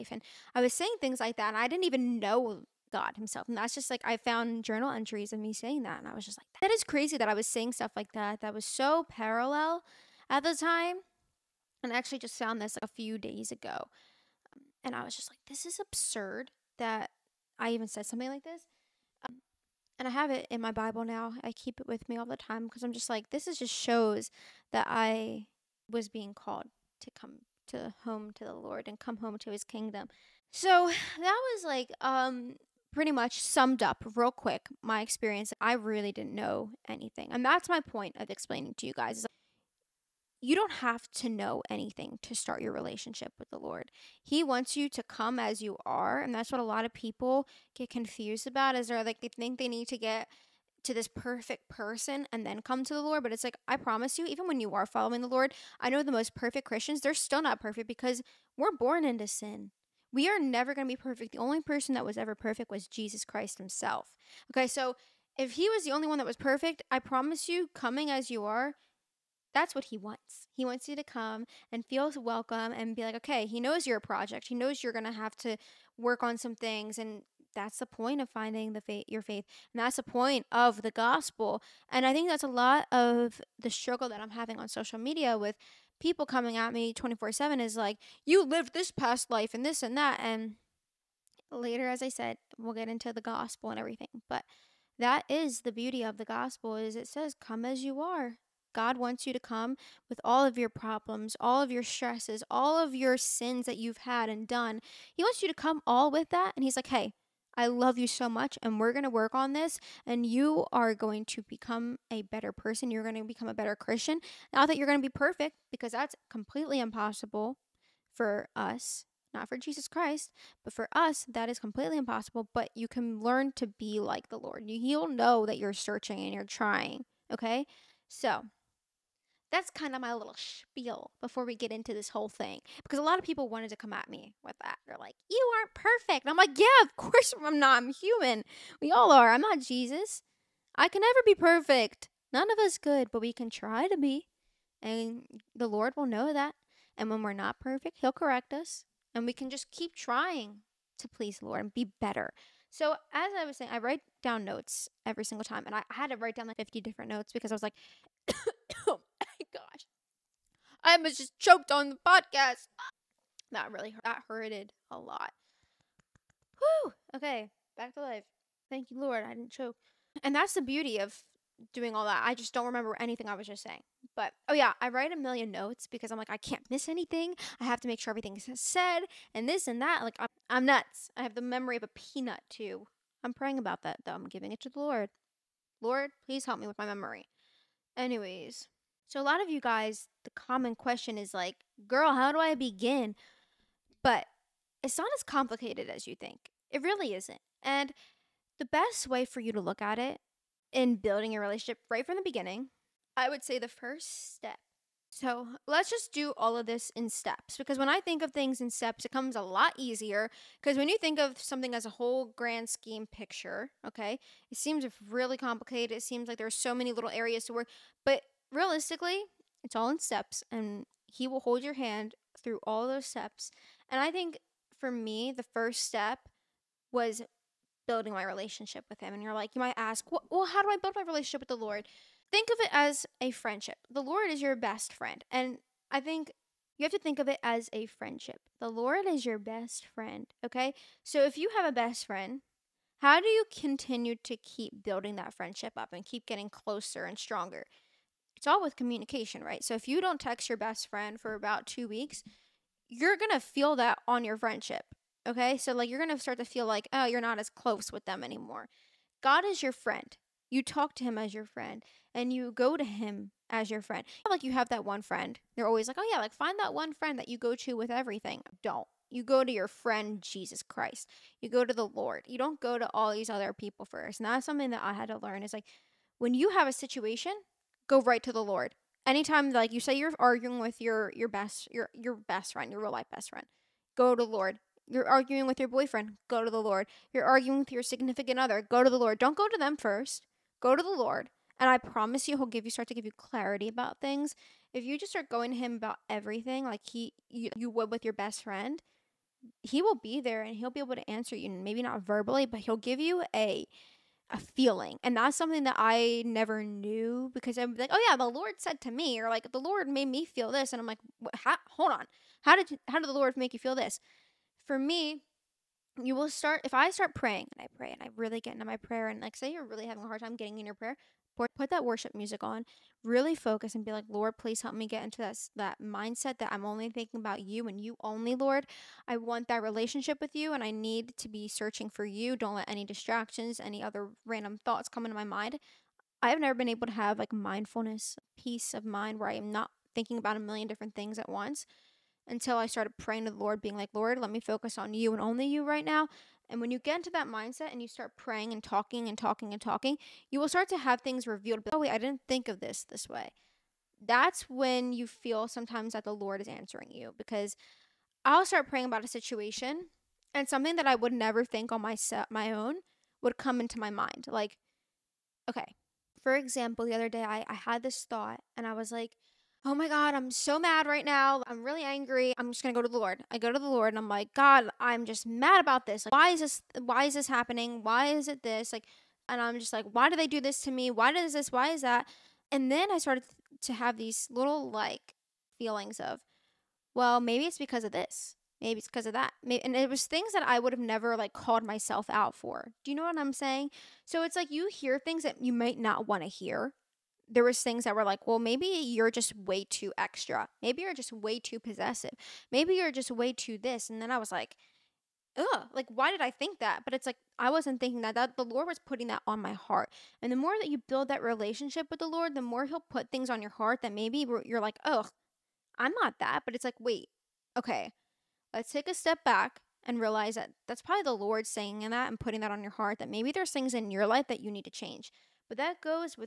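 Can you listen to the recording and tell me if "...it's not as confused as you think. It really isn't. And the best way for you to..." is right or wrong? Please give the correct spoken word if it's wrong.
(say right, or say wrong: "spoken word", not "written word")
wrong: "complicated", not "confused".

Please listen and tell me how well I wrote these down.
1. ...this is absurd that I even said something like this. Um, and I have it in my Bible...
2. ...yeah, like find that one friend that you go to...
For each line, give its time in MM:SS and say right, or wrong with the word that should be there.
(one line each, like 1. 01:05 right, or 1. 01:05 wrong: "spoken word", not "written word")
1. 00:15 right
2. 04:26 right.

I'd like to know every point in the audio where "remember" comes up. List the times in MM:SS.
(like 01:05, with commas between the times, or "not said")
02:52.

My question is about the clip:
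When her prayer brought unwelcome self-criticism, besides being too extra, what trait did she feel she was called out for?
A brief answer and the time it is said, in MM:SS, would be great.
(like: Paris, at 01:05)
Possessive, at 06:41.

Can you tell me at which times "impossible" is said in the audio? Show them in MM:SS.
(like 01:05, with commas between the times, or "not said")
01:56, 02:01.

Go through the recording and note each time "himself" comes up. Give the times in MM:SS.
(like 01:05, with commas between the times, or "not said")
00:03, 01:03.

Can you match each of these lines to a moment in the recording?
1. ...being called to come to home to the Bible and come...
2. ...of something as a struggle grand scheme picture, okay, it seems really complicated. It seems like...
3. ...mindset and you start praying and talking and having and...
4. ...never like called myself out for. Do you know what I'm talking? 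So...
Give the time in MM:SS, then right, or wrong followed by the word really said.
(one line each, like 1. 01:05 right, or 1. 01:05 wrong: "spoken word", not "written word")
1. 00:26 wrong: "Lord", not "Bible"
2. 03:31 wrong: "whole", not "struggle"
3. 05:47 wrong: "talking", not "having"
4. 06:30 wrong: "saying", not "talking".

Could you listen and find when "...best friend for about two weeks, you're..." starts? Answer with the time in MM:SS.
04:10.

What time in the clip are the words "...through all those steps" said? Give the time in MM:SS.
03:42.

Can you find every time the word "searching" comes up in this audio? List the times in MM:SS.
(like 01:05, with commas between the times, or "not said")
02:05, 05:31.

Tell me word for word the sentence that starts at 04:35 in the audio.
Is like when you have a situation go right to the Lord.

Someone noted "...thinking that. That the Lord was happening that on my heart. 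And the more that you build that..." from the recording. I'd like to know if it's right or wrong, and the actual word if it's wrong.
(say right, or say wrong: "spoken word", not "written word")
wrong: "putting", not "happening".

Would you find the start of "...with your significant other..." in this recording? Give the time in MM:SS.
04:47.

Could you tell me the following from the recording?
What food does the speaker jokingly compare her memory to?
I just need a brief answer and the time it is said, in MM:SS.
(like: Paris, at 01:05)
A peanut, at 03:01.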